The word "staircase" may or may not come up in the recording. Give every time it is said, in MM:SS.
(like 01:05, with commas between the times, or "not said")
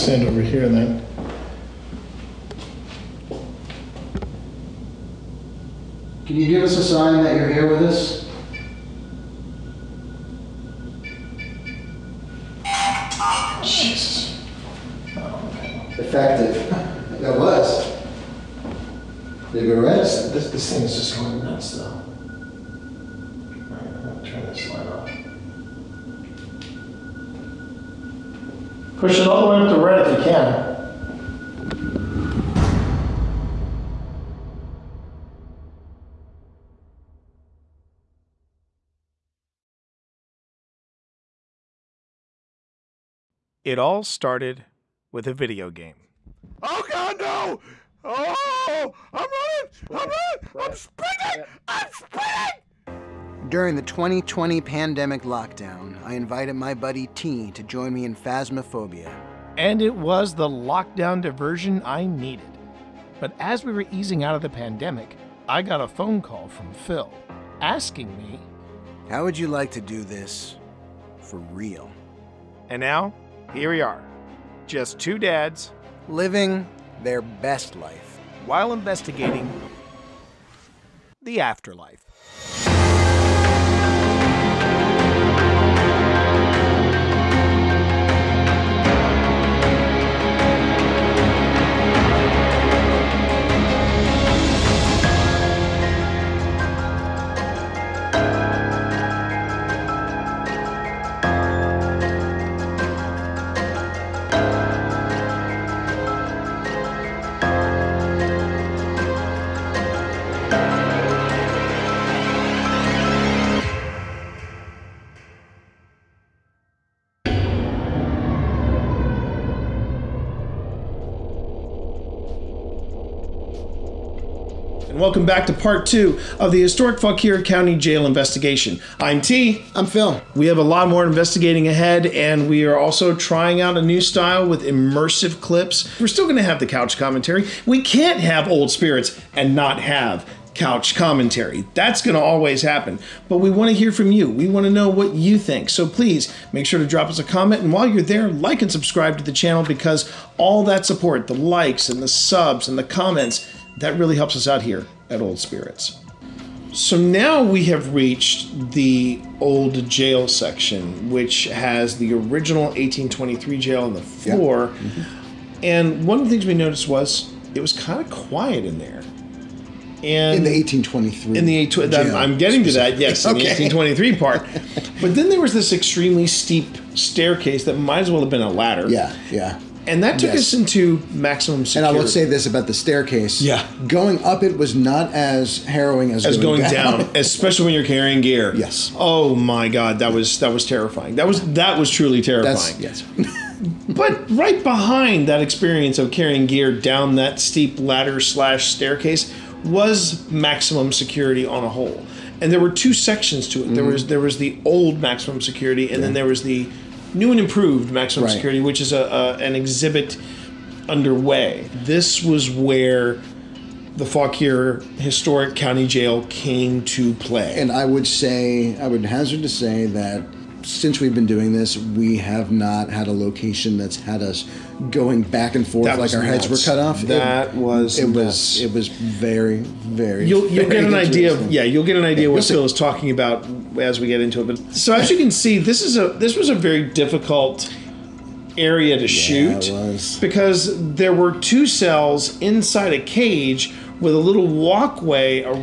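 02:56, 03:02, 03:18.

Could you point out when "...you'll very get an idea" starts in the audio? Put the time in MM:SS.
03:50.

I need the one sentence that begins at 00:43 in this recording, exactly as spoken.
It all started with a video game.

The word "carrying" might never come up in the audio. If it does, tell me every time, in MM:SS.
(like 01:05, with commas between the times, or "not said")
03:07, 03:16.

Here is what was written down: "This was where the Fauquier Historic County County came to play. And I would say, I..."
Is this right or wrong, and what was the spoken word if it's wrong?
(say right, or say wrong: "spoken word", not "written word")
wrong: "Jail", not "County".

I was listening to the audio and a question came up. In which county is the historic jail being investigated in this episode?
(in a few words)
Fauquier County.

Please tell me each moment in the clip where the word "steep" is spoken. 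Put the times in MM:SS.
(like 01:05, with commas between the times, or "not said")
02:56, 03:17.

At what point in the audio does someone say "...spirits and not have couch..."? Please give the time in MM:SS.
02:18.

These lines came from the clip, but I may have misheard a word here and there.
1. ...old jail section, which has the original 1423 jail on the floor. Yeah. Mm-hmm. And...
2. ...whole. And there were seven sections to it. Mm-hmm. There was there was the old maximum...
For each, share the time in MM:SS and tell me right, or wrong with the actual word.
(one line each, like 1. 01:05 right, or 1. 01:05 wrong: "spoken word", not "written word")
1. 02:39 wrong: "1823", not "1423"
2. 03:21 wrong: "two", not "seven".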